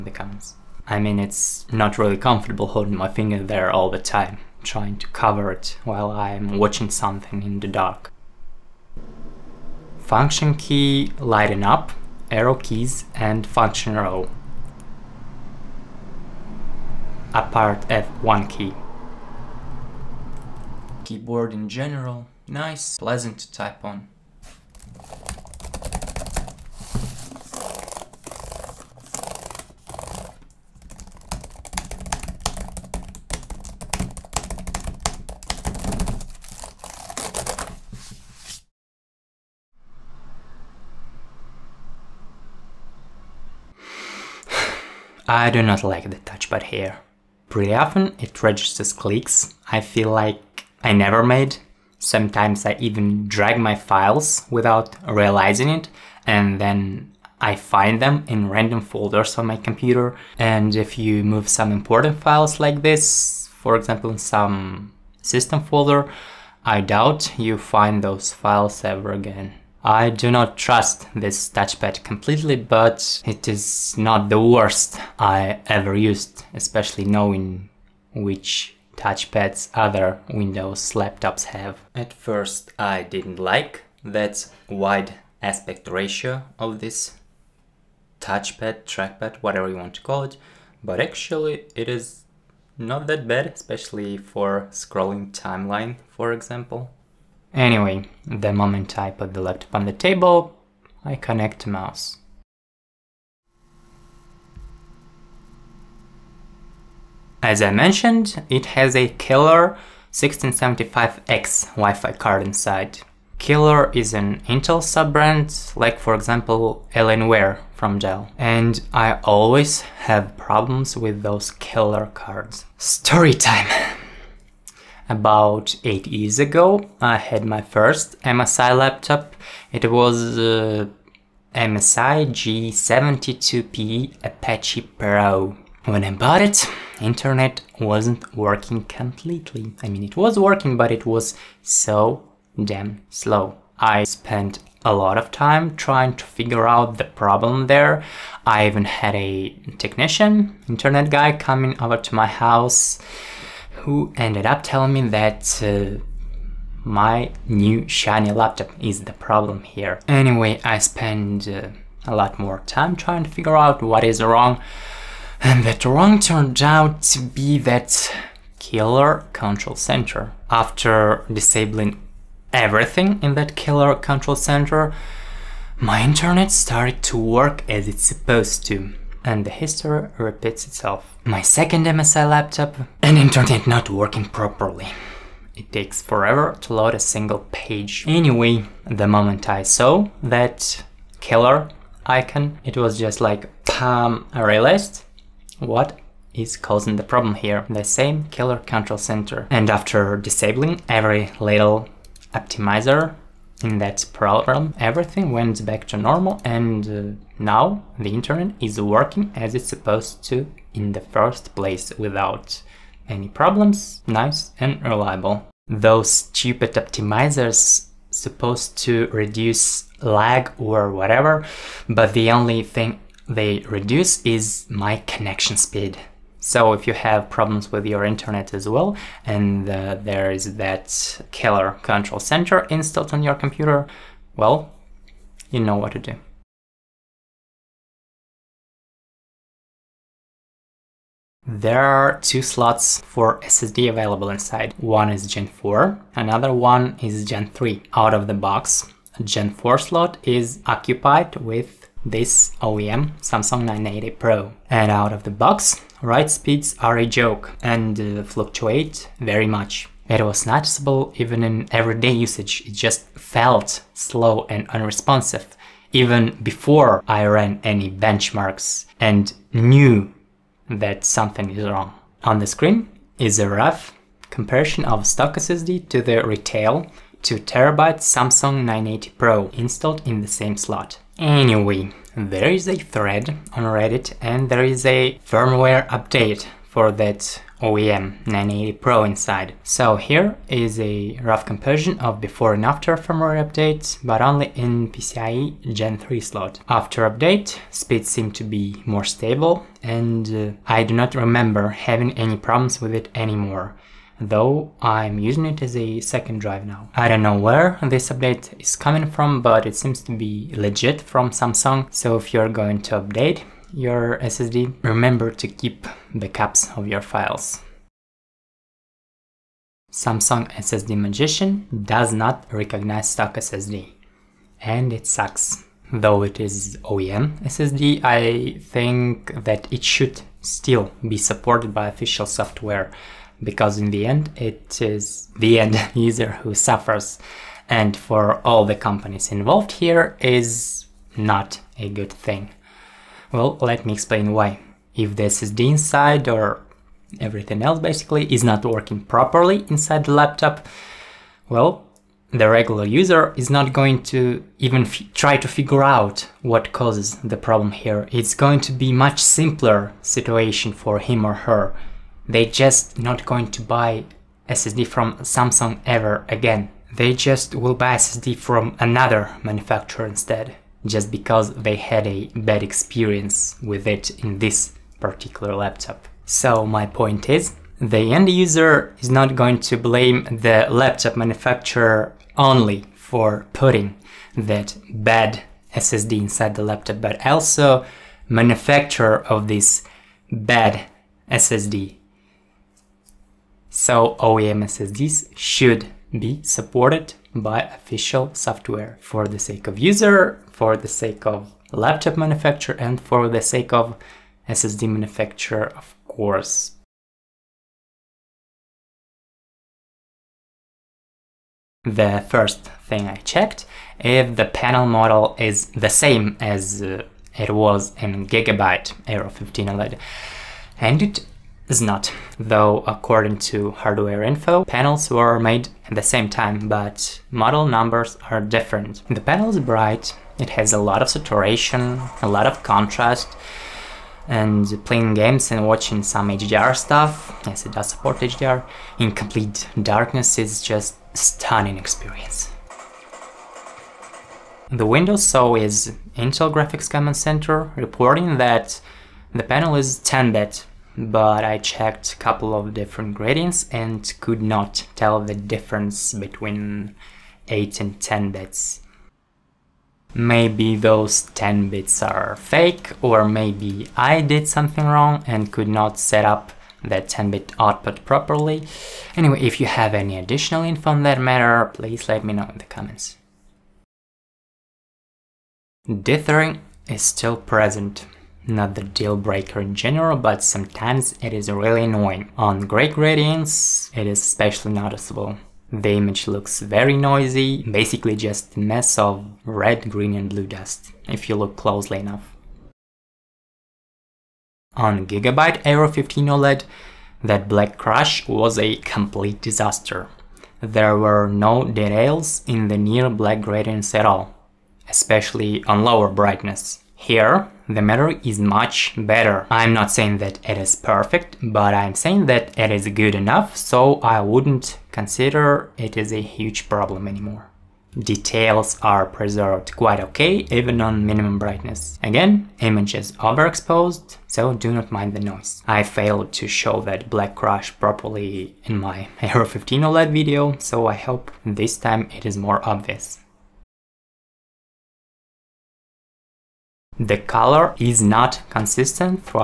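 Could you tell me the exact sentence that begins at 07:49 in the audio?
Anyway, if you have any additional info on that matter, please let me know in the comments.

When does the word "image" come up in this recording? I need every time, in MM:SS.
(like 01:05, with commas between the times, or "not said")
08:05, 08:42.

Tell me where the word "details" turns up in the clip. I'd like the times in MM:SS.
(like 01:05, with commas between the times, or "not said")
08:21, 08:37.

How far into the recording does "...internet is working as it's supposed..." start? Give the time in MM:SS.
03:28.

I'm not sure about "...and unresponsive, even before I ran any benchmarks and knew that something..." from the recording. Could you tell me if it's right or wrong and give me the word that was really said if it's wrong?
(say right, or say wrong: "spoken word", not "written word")
right.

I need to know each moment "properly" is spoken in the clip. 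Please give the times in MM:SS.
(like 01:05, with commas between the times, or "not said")
03:04, 05:49, 07:48, 08:47.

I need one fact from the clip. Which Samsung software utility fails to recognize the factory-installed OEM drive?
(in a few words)
Samsung SSD Magician.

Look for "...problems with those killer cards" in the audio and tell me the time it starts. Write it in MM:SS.
02:00.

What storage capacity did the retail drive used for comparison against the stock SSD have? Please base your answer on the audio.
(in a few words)
2TB.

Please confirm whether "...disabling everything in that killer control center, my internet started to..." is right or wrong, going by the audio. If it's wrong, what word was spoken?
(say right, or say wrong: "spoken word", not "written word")
right.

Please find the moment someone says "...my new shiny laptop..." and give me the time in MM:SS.
02:36.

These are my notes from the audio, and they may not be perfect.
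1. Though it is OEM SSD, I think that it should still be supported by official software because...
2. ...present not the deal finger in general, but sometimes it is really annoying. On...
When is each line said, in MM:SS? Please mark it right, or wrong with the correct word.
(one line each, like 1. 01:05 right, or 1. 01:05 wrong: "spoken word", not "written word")
1. 05:25 right
2. 07:57 wrong: "breaker", not "finger".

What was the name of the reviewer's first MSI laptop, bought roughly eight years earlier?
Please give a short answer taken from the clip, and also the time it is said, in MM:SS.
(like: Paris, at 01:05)
MSI G72P Apache Pro, at 02:11.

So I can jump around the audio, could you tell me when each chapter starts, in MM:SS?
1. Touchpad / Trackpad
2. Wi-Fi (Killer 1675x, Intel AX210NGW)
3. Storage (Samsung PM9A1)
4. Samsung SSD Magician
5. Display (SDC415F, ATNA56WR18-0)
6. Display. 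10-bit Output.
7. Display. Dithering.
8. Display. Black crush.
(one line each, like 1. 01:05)
1. 00:43
2. 01:47
3. 04:01
4. 05:19
5. 06:51
6. 07:24
7. 07:55
8. 08:14.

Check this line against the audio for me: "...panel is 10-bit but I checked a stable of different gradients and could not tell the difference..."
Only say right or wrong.
wrong.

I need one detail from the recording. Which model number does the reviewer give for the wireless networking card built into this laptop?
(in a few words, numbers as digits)
Killer 1675X.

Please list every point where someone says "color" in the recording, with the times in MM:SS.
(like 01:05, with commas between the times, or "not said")
08:57.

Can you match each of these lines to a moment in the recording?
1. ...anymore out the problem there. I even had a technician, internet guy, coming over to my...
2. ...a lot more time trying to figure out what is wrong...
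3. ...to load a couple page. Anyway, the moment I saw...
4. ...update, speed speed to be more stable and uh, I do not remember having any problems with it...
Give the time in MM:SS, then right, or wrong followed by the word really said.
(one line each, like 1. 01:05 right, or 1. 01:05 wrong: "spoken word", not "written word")
1. 02:26 wrong: "figure", not "anymore"
2. 02:42 right
3. 03:06 wrong: "single", not "couple"
4. 04:57 wrong: "seemed", not "speed".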